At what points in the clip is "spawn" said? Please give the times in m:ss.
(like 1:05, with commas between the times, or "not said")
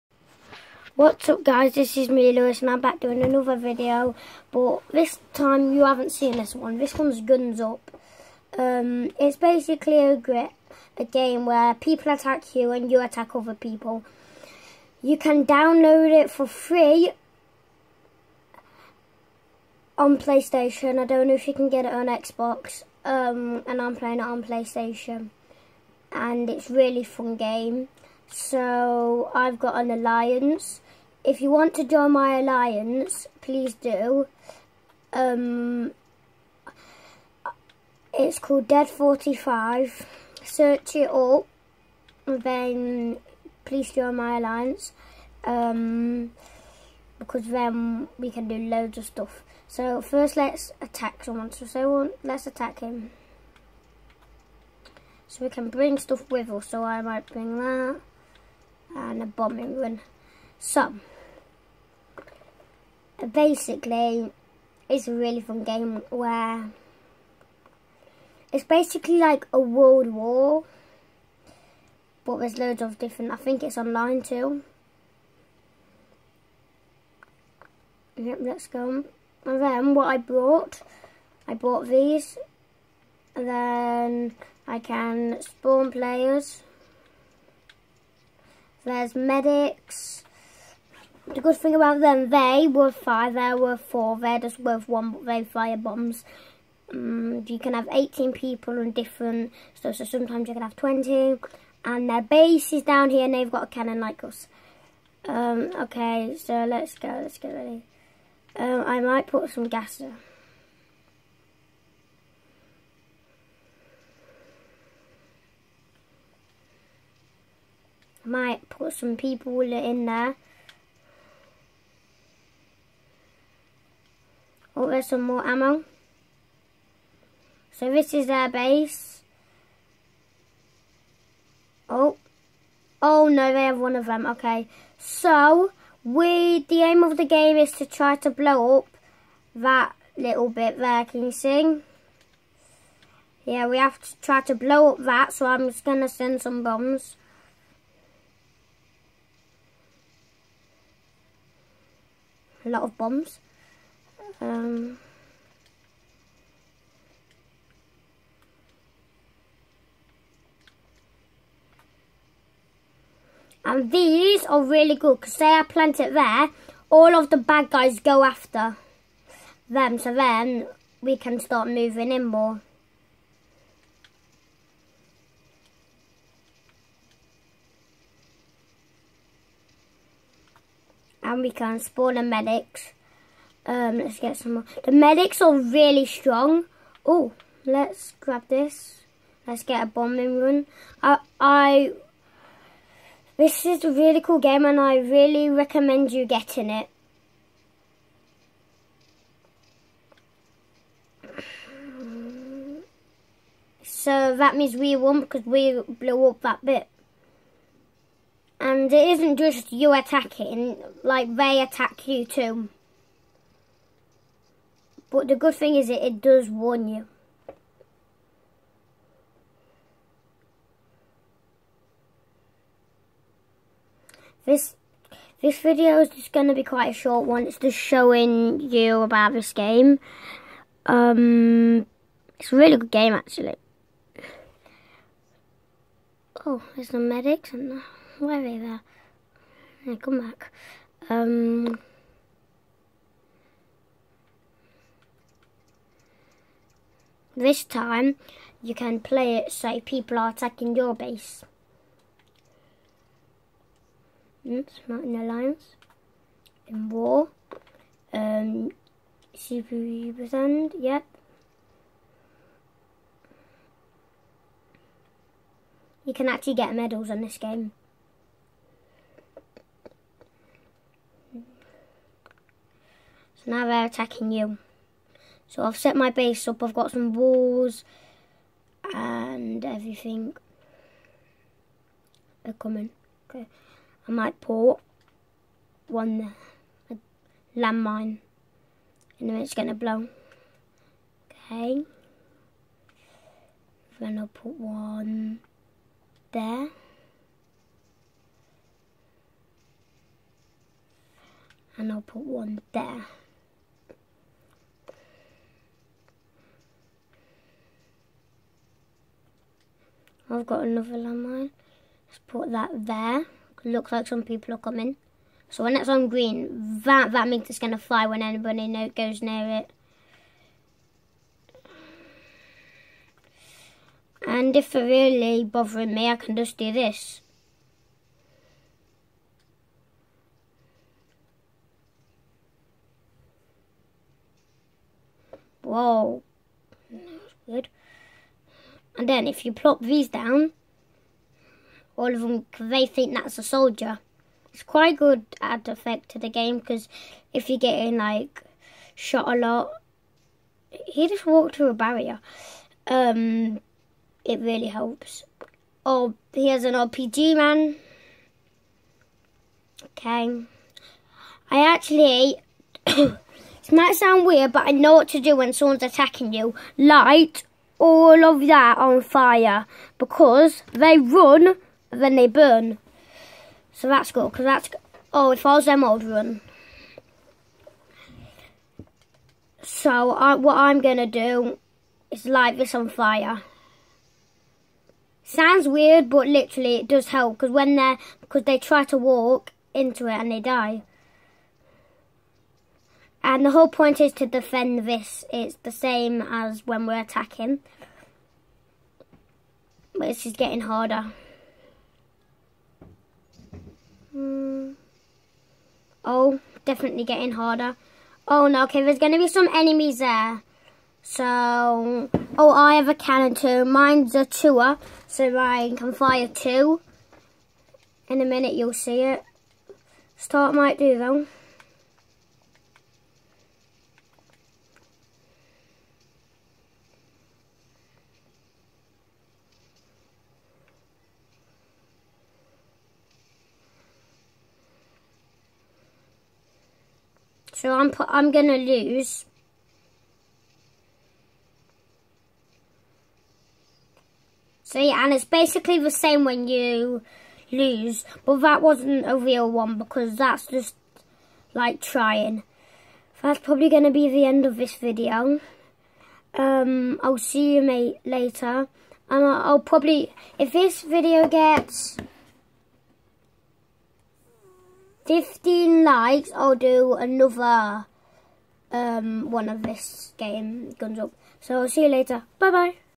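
1:25, 3:01.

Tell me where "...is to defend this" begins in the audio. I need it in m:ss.
6:34.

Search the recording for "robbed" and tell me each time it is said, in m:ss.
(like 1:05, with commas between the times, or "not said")
not said.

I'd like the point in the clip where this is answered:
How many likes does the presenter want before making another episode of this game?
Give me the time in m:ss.
7:45.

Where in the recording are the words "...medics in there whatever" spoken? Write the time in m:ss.
3:56.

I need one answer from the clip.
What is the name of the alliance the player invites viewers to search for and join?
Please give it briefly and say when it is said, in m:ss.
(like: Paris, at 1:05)
Dead 45, at 0:38.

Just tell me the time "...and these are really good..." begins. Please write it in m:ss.
2:43.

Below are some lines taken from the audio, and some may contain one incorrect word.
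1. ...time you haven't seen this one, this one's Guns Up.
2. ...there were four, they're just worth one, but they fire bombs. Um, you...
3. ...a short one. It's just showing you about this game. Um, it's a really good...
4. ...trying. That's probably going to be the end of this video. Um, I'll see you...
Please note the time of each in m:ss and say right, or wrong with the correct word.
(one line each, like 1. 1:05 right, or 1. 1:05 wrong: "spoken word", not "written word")
1. 0:05 right
2. 1:33 right
3. 3:46 right
4. 7:31 right.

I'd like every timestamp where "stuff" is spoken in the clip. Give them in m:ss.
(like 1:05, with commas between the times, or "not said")
0:49, 0:55, 1:39.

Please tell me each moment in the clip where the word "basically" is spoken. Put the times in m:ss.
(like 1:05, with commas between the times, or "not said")
0:09, 1:03, 1:08, 7:25.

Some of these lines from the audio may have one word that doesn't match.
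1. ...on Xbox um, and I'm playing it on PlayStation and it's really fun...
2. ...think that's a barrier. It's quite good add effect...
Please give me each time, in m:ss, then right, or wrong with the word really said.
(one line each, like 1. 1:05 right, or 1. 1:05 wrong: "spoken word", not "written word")
1. 0:21 right
2. 5:42 wrong: "soldier", not "barrier".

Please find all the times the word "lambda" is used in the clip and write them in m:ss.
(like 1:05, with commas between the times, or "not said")
not said.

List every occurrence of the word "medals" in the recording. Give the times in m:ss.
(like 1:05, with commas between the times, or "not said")
4:26.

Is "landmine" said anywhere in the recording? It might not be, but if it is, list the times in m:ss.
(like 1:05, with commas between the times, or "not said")
4:47, 5:10.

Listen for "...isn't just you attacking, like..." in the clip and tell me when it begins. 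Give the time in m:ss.
3:29.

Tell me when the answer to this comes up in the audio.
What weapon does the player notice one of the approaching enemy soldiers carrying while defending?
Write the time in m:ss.
5:56.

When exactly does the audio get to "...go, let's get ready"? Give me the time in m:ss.
1:46.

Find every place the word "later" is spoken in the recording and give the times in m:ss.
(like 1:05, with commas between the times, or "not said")
7:38, 7:51.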